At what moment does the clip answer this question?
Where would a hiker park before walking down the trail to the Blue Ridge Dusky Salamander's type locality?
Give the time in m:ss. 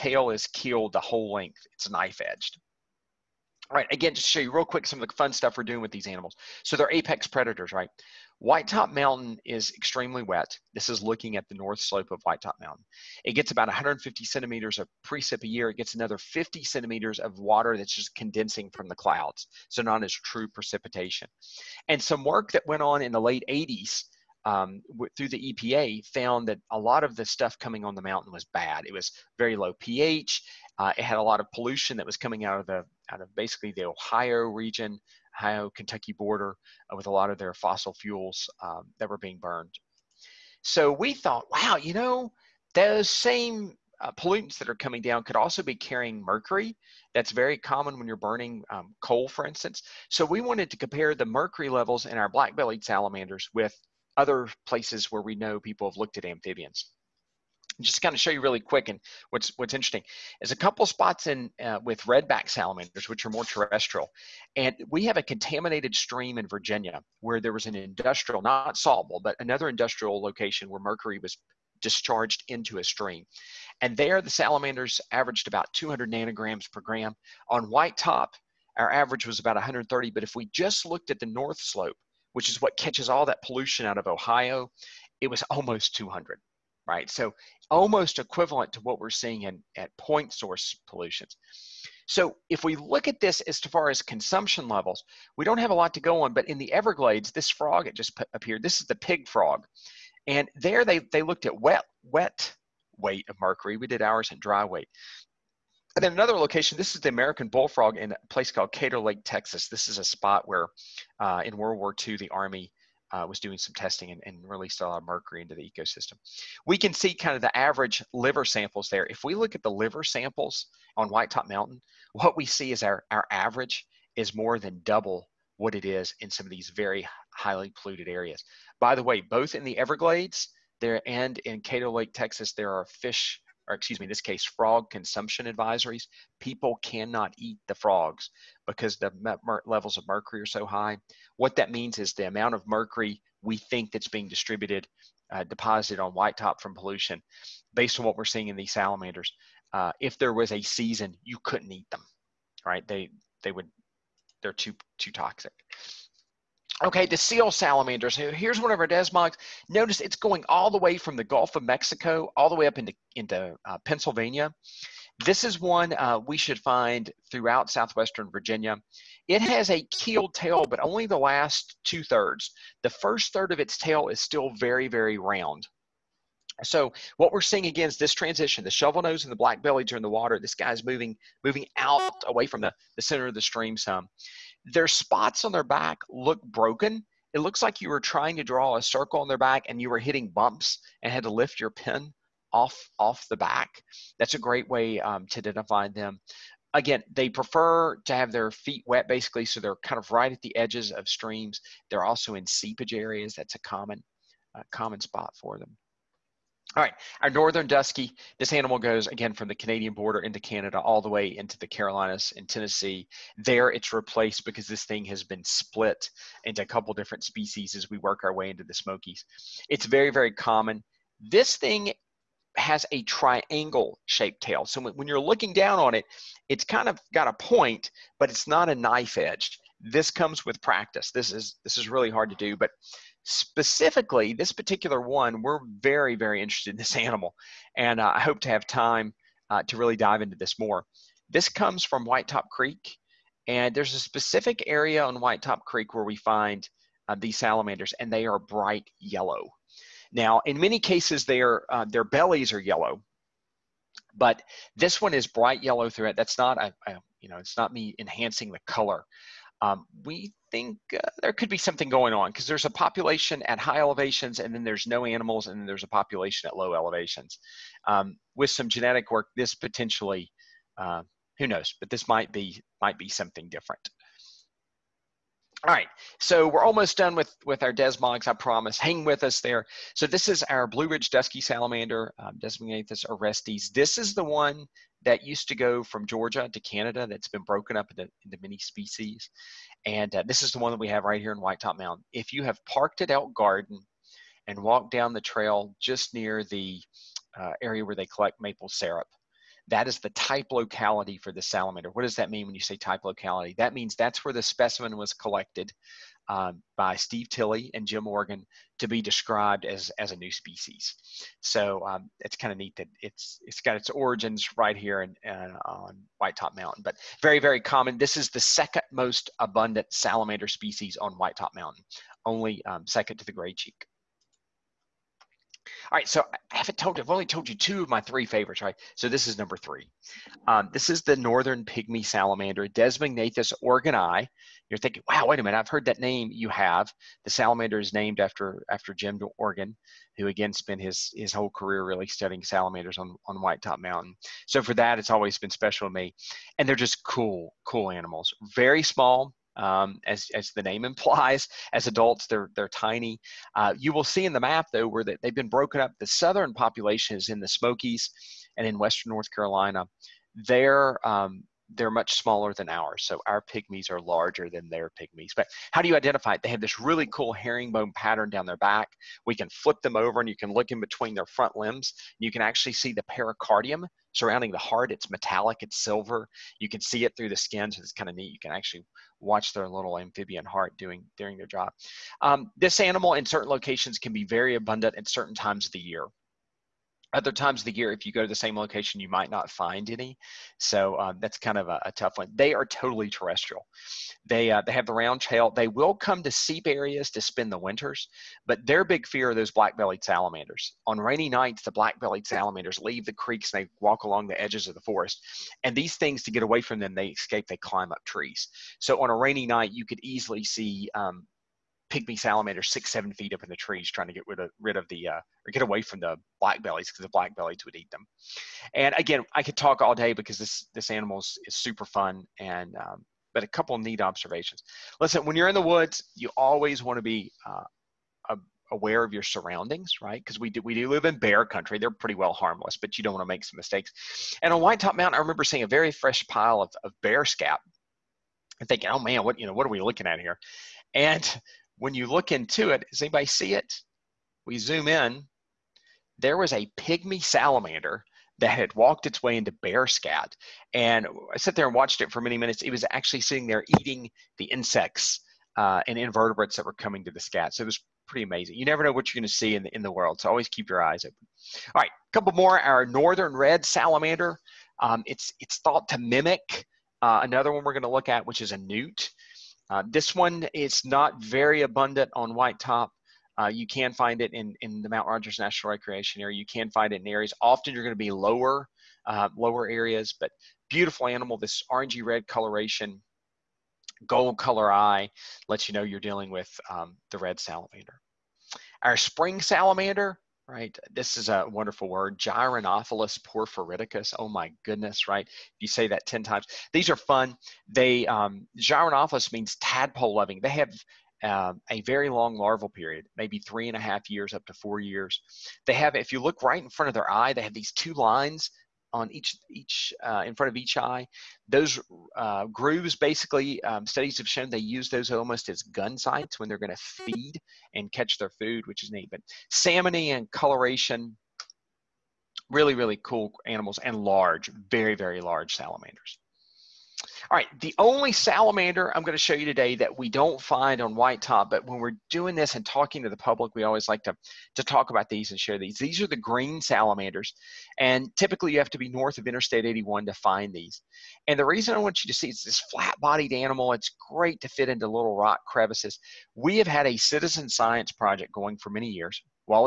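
4:53.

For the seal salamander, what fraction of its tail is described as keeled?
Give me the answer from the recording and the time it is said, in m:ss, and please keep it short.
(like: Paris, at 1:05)
the last two thirds, at 2:51.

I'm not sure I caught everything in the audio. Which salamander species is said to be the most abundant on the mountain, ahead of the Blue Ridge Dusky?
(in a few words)
gray cheek.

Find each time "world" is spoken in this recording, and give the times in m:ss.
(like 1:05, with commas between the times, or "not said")
1:51, 7:39.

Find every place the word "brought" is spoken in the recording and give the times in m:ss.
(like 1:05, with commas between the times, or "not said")
not said.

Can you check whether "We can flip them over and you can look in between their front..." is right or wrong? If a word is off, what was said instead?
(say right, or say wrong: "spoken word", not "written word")
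right.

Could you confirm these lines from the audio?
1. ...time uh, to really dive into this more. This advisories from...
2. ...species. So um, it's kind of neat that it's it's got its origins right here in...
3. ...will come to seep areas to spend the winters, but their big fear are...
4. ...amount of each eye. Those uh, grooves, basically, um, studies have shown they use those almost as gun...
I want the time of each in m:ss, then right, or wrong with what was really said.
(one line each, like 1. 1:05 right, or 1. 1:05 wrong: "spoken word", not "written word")
1. 3:58 wrong: "comes", not "advisories"
2. 5:10 right
3. 6:35 right
4. 8:30 wrong: "front", not "amount".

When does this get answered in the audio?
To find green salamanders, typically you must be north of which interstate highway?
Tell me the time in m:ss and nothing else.
8:59.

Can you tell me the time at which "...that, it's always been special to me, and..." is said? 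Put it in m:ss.
5:44.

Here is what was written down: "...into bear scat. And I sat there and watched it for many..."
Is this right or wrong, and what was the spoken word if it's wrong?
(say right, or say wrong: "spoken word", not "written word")
right.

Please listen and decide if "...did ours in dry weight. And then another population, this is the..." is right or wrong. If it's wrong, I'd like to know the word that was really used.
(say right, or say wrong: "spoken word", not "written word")
wrong: "location", not "population".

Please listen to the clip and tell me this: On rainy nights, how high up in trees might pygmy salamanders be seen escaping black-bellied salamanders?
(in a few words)
6 to 7 feet.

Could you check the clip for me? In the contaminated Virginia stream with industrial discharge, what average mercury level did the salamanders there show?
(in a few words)
200 nanograms per gram.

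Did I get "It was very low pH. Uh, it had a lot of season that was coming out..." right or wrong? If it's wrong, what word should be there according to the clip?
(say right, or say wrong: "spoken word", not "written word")
wrong: "pollution", not "season".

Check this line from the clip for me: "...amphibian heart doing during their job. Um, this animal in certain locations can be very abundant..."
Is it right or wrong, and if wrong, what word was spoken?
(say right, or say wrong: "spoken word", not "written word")
right.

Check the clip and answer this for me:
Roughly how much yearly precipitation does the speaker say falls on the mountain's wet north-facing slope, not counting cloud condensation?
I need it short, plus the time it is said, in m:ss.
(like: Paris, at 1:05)
150 centimeters, at 0:13.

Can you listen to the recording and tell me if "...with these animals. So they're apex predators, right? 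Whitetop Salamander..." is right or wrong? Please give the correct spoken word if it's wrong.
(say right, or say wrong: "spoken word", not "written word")
wrong: "Mountain", not "Salamander".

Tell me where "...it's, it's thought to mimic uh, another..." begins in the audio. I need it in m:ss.
7:45.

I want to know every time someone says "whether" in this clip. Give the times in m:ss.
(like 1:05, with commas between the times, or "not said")
not said.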